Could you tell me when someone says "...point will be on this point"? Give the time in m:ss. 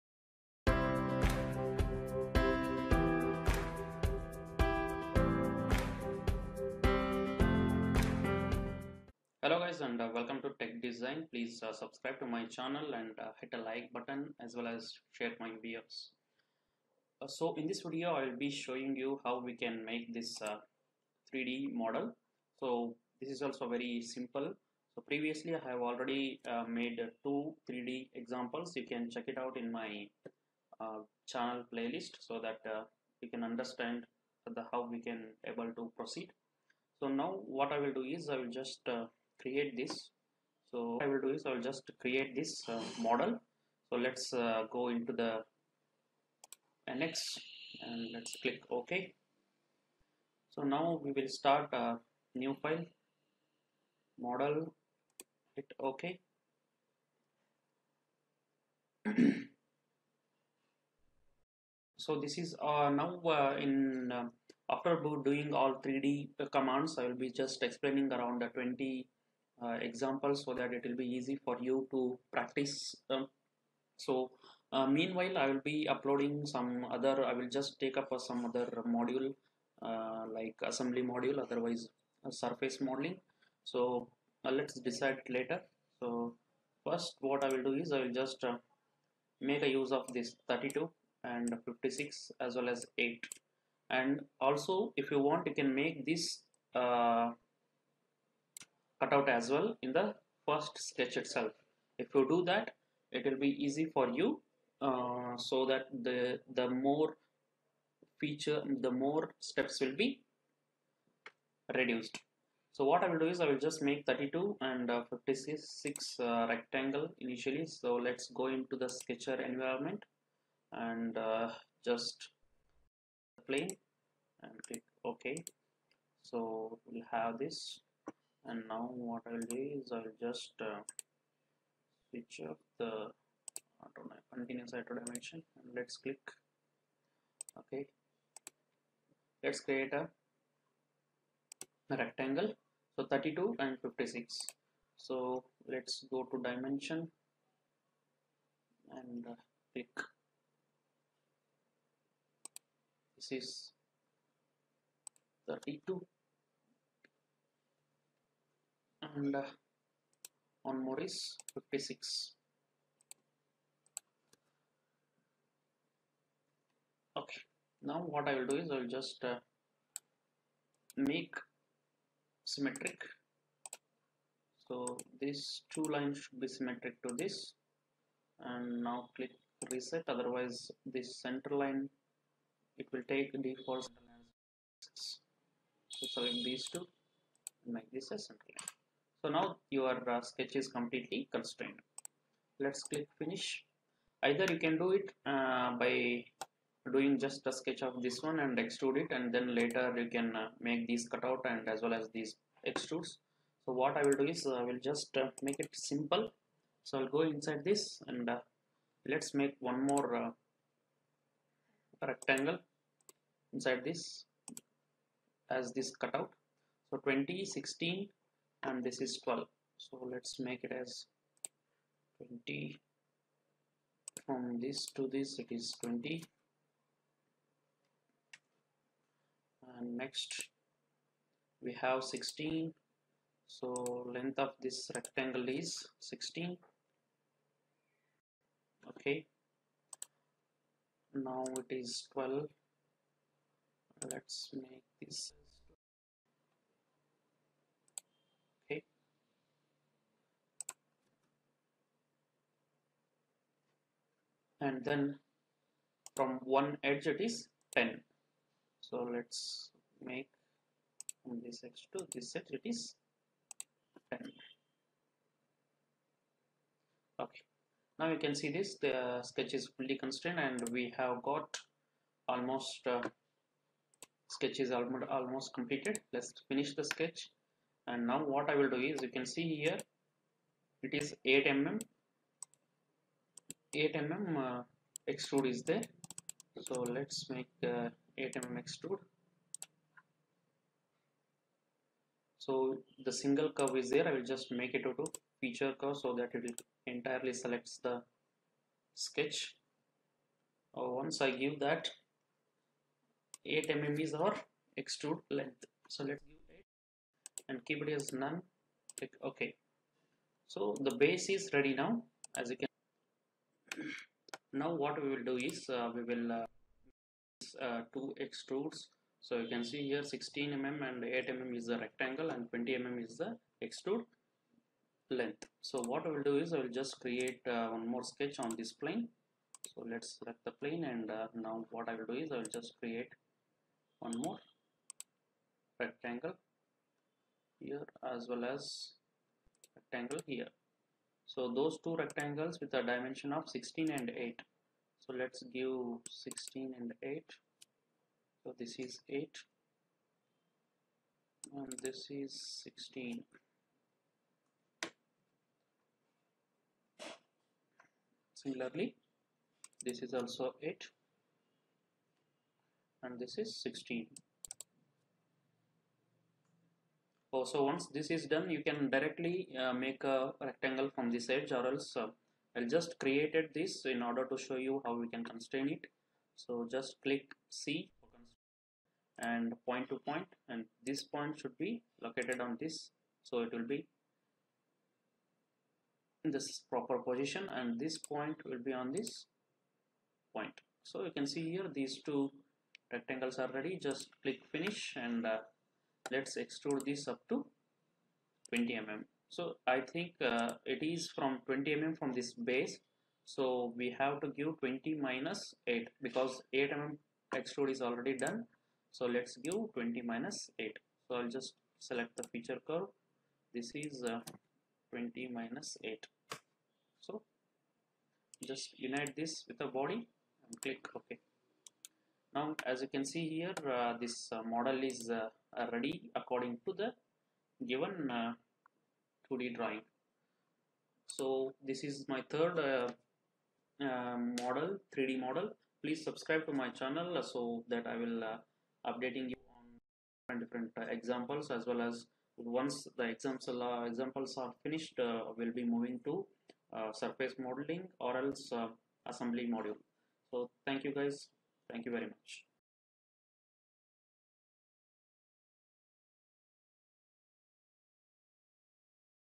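6:27.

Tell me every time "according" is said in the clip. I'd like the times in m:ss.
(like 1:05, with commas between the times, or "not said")
7:06.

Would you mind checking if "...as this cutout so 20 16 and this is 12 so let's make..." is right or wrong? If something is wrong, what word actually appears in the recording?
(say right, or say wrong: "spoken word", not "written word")
right.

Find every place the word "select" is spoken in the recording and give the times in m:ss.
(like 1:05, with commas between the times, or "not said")
3:06, 4:57, 5:30, 6:51.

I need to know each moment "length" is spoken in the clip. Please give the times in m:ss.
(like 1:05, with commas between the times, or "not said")
3:54, 5:05, 5:25.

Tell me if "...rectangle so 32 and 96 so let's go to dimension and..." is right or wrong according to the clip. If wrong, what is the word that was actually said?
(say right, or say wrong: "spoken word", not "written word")
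wrong: "56", not "96".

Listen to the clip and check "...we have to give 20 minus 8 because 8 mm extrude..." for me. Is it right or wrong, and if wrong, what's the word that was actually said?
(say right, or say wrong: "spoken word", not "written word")
right.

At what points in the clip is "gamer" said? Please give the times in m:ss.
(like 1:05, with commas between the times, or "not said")
not said.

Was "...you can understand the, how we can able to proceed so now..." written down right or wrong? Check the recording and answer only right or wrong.
right.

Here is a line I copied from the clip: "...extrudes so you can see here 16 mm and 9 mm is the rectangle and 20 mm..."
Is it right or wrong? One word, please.
wrong.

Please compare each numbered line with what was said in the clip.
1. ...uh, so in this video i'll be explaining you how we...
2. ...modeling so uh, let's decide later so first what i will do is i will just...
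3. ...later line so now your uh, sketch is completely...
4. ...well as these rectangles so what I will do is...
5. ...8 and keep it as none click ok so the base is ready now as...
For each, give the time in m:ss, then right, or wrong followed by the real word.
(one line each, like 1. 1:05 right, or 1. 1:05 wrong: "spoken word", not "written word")
1. 0:17 wrong: "showing", not "explaining"
2. 1:22 right
3. 3:08 wrong: "center", not "later"
4. 3:21 wrong: "extrudes", not "rectangles"
5. 5:07 right.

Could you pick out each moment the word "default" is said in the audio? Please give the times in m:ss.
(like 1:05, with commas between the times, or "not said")
3:03.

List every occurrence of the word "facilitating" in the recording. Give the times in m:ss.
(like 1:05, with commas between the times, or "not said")
not said.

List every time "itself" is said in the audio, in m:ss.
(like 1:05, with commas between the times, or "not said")
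1:41.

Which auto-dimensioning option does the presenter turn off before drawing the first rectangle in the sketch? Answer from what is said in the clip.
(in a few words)
continuous auto dimension.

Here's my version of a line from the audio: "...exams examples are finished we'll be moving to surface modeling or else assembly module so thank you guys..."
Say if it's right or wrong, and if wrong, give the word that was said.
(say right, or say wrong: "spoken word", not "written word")
right.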